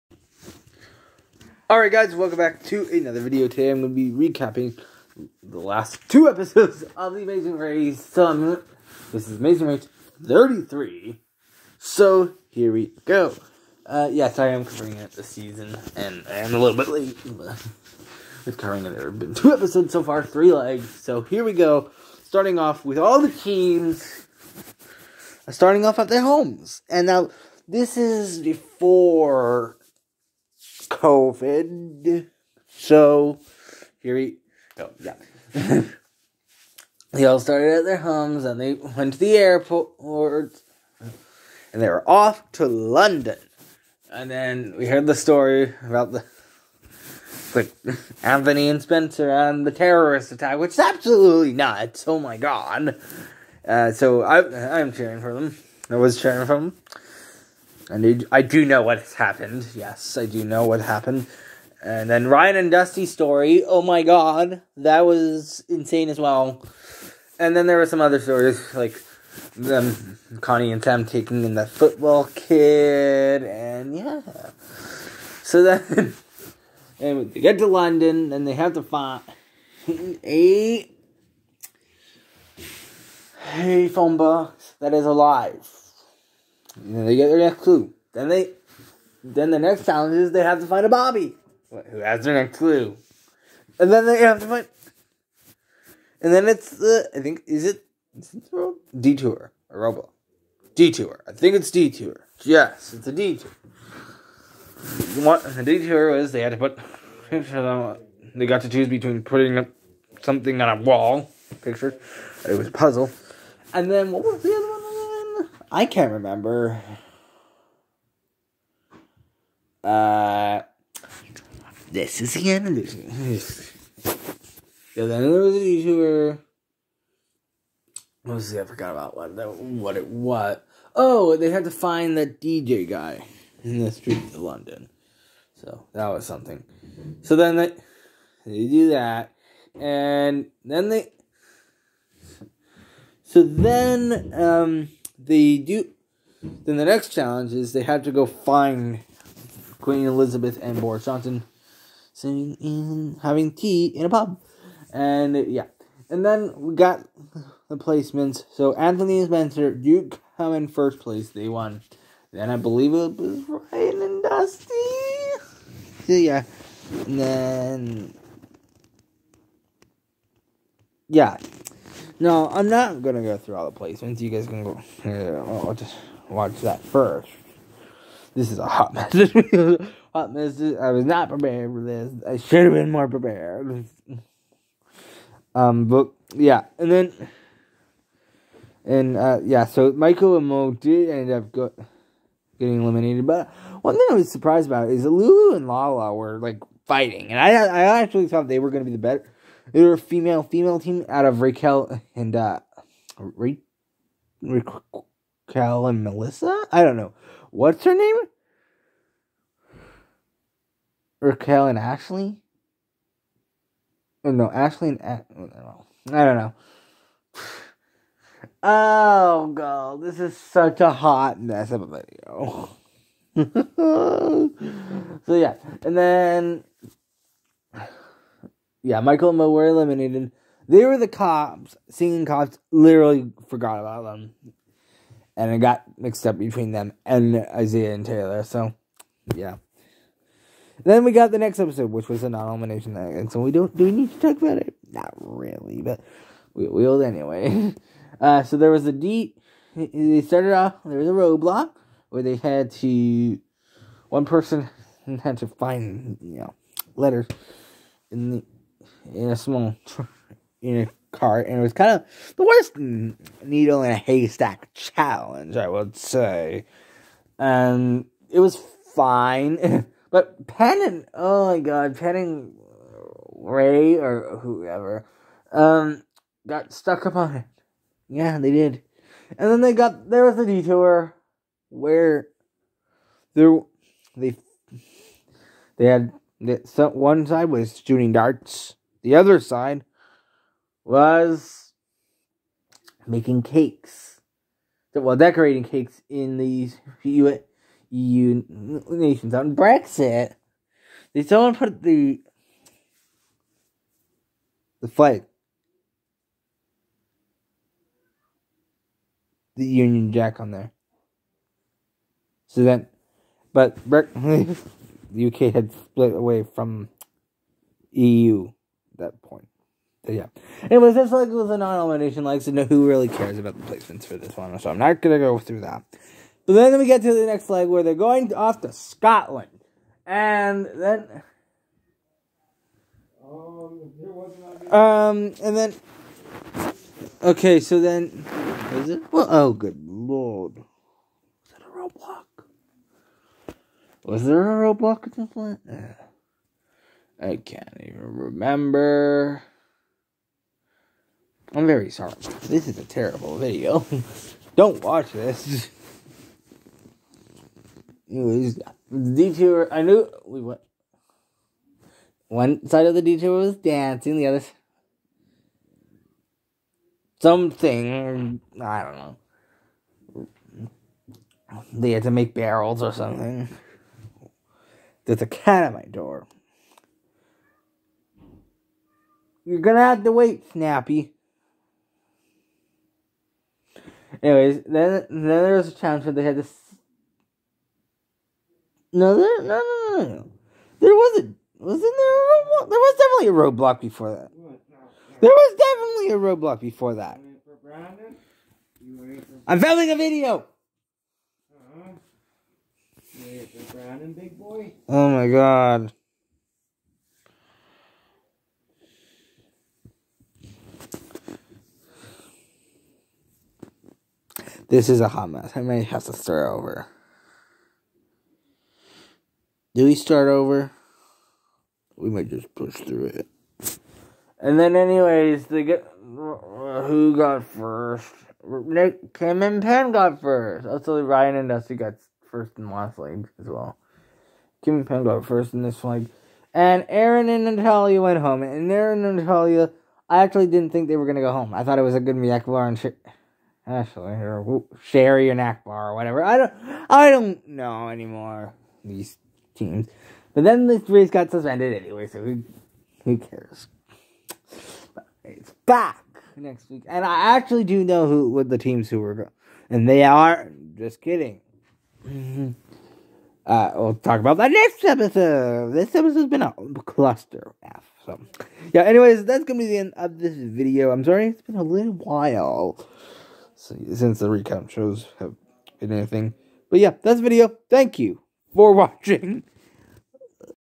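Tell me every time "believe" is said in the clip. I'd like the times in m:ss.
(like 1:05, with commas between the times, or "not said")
2:42.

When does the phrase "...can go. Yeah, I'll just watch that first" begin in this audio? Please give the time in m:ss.
2:54.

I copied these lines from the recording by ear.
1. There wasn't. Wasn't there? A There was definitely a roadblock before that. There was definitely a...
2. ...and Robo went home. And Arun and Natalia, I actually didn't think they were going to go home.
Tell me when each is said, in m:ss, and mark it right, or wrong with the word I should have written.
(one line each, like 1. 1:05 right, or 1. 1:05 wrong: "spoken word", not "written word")
1. 6:30 right
2. 7:17 wrong: "Natalia", not "Robo".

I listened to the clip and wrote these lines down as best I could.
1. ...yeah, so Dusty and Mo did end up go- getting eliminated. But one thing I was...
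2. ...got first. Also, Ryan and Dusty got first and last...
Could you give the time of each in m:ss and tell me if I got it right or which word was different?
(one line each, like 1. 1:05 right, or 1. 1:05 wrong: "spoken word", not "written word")
1. 3:09 wrong: "Michael", not "Dusty"
2. 7:09 right.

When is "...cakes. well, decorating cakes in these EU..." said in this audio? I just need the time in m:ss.
4:53.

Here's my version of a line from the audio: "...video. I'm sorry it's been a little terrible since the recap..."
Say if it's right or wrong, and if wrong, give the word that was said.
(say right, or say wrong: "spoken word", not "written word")
wrong: "while", not "terrible".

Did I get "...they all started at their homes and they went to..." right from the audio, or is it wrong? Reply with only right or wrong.
right.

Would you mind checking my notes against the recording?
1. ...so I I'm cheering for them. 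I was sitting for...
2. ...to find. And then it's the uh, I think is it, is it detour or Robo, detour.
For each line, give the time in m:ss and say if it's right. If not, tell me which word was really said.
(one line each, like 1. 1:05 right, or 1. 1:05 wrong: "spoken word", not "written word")
1. 0:53 wrong: "cheering", not "sitting"
2. 1:34 right.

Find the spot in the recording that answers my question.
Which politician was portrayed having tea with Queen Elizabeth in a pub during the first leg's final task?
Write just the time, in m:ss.
2:30.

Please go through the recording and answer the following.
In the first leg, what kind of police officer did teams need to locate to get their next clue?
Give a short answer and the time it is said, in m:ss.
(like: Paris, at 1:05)
A Bobby, at 1:30.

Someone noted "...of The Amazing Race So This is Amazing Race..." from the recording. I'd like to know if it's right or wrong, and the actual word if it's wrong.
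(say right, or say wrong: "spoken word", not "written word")
right.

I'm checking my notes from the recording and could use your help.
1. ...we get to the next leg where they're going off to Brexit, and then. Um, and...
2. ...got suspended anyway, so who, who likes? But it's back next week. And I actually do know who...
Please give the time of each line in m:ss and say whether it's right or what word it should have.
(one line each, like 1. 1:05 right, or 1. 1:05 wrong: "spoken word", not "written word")
1. 5:26 wrong: "Scotland", not "Brexit"
2. 7:31 wrong: "cares", not "likes".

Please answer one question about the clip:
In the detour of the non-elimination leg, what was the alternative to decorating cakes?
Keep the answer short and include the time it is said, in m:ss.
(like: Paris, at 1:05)
Shooting darts, at 4:47.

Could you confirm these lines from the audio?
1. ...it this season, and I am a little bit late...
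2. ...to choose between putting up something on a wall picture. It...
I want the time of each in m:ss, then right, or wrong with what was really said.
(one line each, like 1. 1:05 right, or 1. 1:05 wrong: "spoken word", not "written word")
1. 0:14 right
2. 1:48 right.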